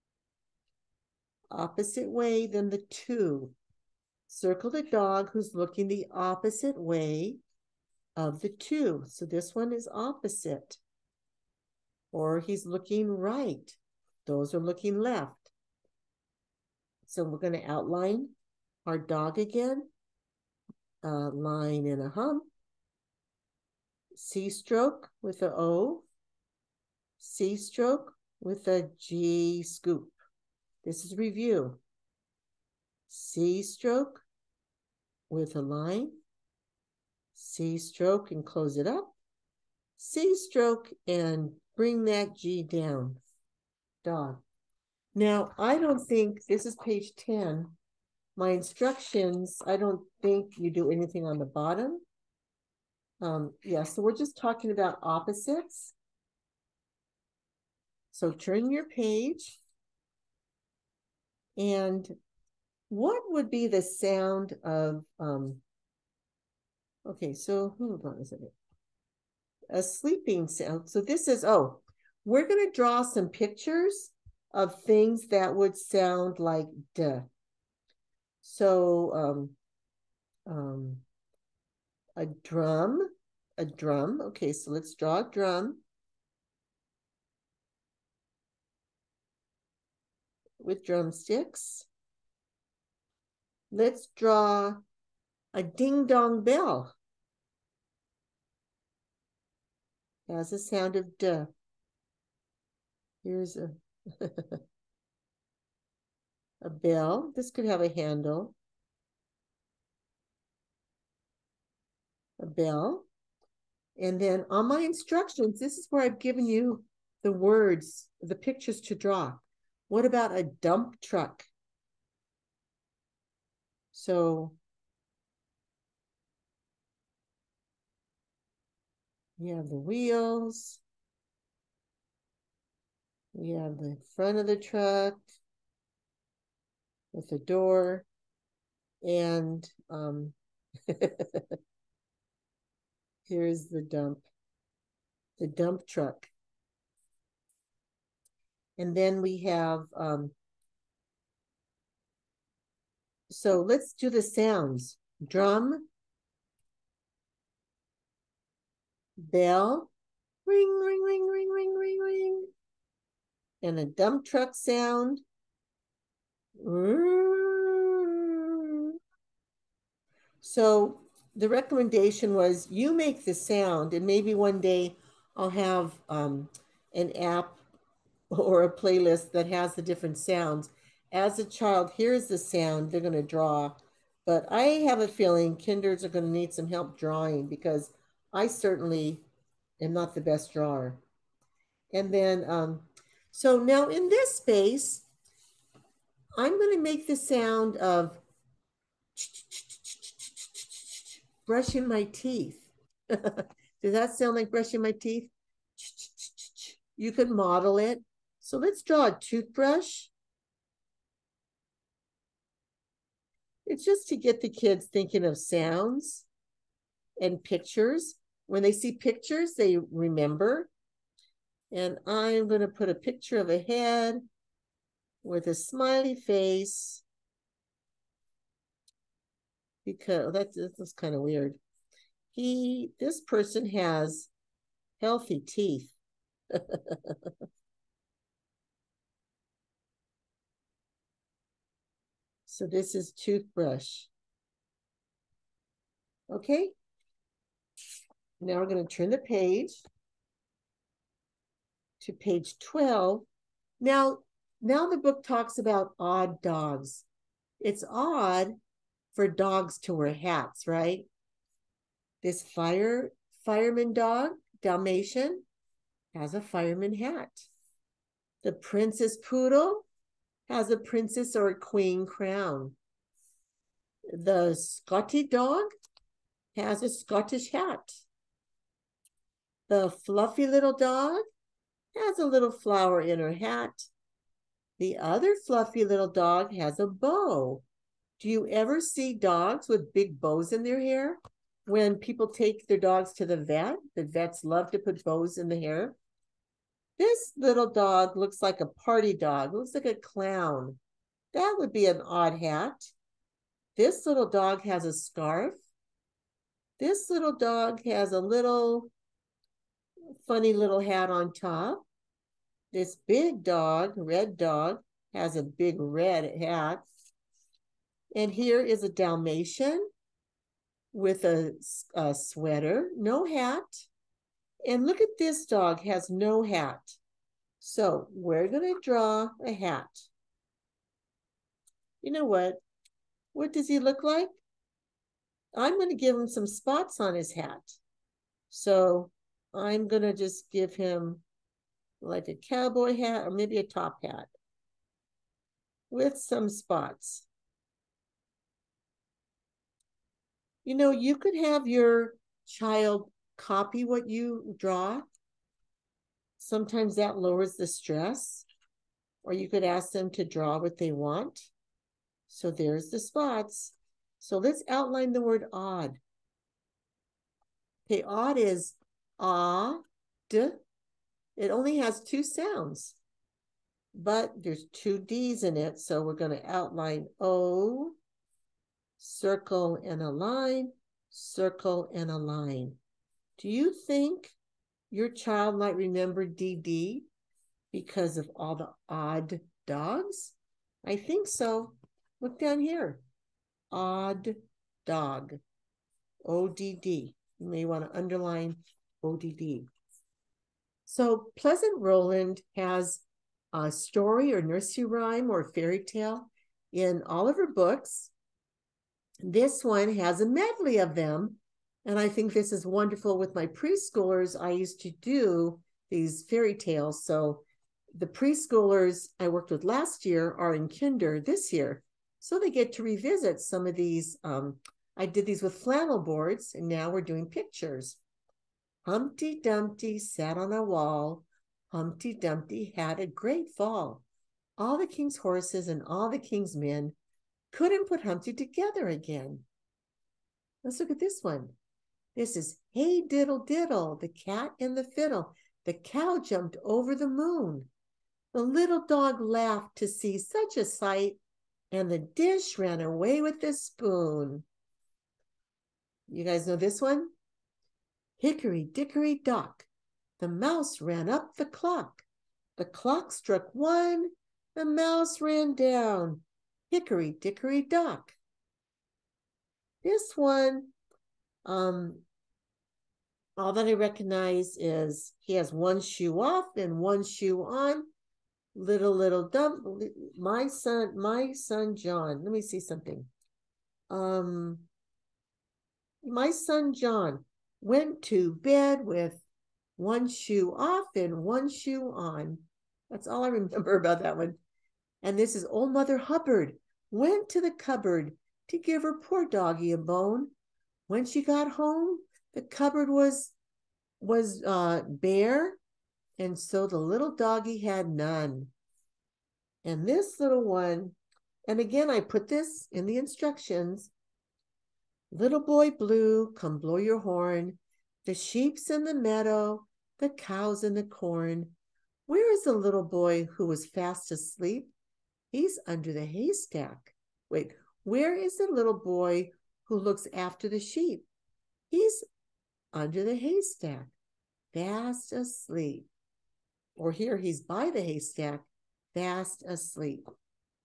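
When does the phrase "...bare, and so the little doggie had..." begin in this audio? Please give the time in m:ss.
8:24.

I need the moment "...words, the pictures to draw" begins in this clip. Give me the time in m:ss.
1:57.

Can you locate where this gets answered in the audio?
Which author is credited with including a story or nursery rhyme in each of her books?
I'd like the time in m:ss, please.
6:41.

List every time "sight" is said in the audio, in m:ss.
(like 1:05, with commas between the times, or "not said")
7:30.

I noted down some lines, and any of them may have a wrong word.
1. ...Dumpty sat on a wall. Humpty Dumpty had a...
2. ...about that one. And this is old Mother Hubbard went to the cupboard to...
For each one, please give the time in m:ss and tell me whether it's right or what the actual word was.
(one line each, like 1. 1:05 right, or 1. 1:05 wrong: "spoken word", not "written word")
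1. 7:09 right
2. 8:13 right.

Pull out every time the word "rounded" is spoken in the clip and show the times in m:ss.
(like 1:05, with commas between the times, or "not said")
not said.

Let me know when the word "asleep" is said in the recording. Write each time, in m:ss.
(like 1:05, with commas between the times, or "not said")
8:44, 8:55, 8:59.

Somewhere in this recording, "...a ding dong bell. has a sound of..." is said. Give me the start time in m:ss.
1:35.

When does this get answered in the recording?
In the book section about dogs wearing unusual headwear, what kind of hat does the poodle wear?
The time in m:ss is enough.
4:32.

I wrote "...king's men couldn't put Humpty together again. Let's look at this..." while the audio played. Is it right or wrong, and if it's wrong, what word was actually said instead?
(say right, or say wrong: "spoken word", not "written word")
right.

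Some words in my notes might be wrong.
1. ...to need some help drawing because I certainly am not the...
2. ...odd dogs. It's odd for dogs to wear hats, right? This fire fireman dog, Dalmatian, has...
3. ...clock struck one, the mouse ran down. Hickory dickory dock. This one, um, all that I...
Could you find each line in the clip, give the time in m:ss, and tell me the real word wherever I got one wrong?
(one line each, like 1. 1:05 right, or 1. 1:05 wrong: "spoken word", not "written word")
1. 3:06 right
2. 4:15 right
3. 7:42 right.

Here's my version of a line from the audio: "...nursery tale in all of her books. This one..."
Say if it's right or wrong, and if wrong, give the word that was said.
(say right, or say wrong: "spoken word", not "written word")
wrong: "fairy", not "nursery".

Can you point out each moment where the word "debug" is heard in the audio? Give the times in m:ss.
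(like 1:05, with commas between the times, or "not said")
not said.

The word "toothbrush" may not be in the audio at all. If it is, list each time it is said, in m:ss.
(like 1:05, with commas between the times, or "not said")
3:29, 4:03.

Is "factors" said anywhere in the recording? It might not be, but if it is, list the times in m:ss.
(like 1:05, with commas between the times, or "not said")
not said.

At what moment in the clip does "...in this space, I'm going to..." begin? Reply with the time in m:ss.
3:13.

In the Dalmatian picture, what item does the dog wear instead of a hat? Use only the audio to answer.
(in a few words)
Sweater.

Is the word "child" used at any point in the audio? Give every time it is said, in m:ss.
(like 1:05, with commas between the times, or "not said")
3:01, 5:52, 6:25.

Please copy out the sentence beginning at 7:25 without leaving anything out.
The cow jumped over the moon.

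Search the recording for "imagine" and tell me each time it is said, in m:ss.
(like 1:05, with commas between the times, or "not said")
not said.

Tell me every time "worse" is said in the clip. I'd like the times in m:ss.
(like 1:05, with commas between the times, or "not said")
not said.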